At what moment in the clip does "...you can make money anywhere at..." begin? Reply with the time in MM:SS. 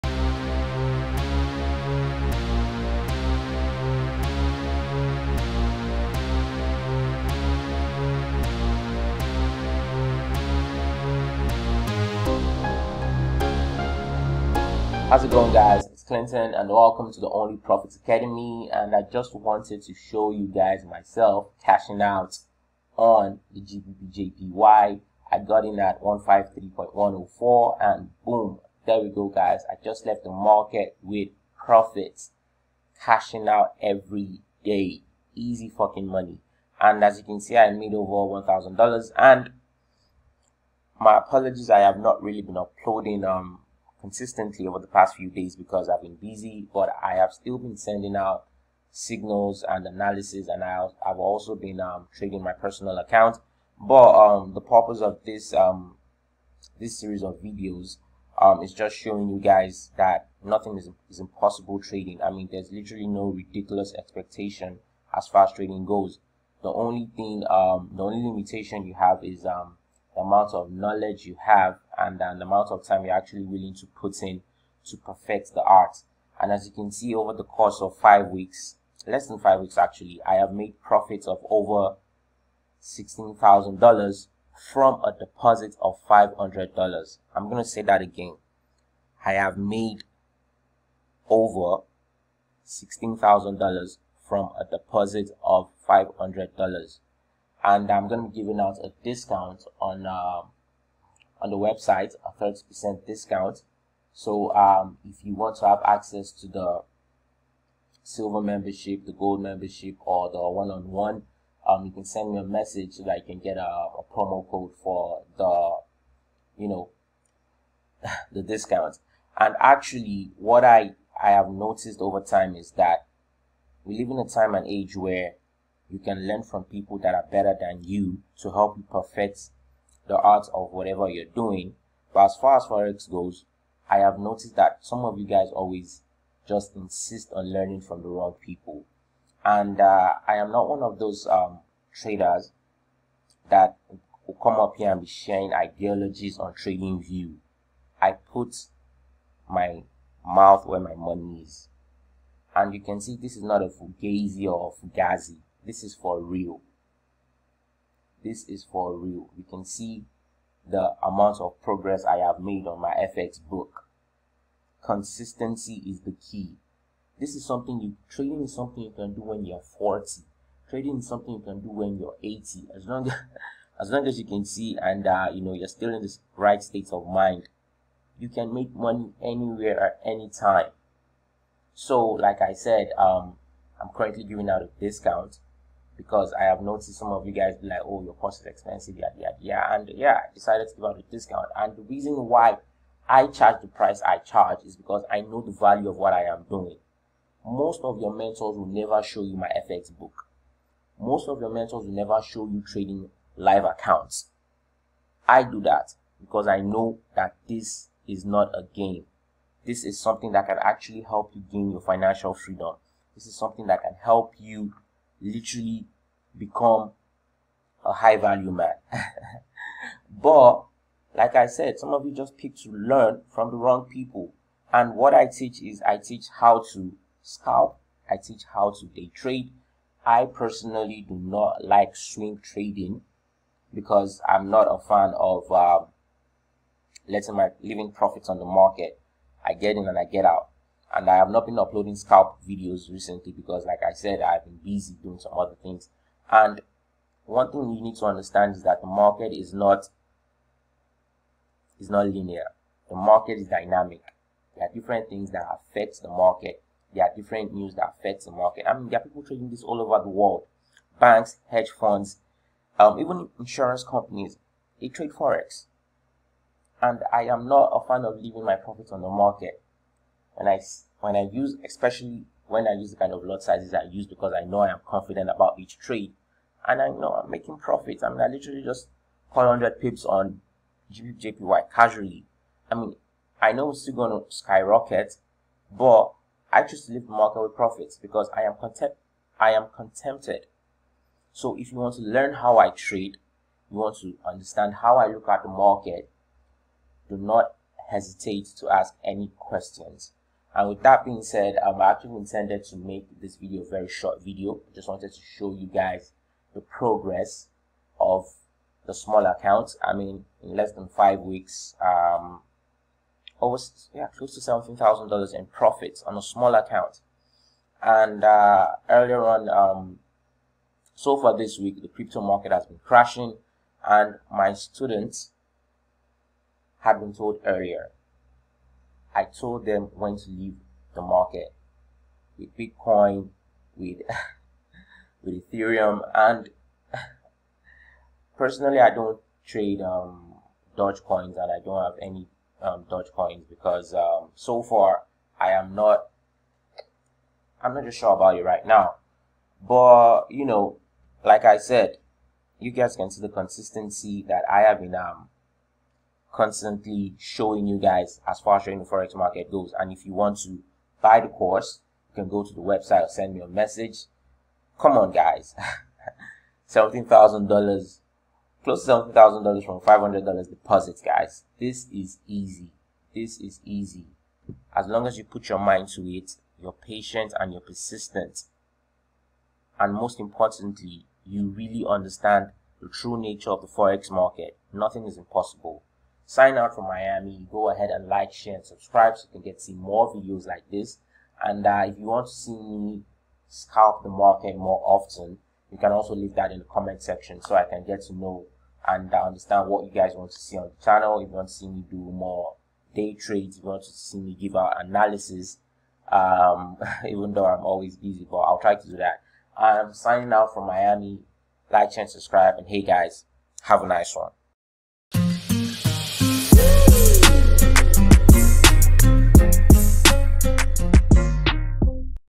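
02:58.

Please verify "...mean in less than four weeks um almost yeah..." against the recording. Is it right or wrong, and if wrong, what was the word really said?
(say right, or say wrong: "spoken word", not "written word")
wrong: "five", not "four".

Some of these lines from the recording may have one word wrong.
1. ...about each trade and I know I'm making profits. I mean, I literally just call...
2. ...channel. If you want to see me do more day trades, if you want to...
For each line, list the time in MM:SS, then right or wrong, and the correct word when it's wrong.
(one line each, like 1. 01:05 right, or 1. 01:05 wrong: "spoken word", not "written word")
1. 04:35 right
2. 06:40 right.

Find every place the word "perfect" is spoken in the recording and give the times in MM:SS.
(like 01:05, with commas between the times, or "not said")
01:14, 02:08.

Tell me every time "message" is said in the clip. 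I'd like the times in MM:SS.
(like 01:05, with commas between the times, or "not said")
01:52, 06:03.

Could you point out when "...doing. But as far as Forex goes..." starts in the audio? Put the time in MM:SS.
02:11.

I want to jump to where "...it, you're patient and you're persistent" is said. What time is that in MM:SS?
06:16.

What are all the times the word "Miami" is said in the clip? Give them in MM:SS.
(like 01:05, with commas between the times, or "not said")
06:26, 06:50.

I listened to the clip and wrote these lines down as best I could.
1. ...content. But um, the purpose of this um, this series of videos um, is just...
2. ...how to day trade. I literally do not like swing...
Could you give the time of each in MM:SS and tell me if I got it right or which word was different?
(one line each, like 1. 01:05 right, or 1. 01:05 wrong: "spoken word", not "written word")
1. 00:52 wrong: "account", not "content"
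2. 03:48 wrong: "personally", not "literally".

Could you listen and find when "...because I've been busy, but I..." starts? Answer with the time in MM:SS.
00:45.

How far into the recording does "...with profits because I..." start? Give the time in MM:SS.
04:47.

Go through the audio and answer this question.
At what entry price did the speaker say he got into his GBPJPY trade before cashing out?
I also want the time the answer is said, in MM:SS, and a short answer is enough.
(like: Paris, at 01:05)
153.104, at 00:26.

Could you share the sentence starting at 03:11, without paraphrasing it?
And the reason why I charge the price I charge is because I know the value of what I am doing.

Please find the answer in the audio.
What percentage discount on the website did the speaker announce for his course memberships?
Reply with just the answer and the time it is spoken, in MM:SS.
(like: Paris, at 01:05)
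30%, at 01:42.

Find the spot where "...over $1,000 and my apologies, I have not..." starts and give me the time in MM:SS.
00:37.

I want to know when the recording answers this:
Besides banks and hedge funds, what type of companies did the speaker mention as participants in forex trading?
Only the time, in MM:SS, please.
04:23.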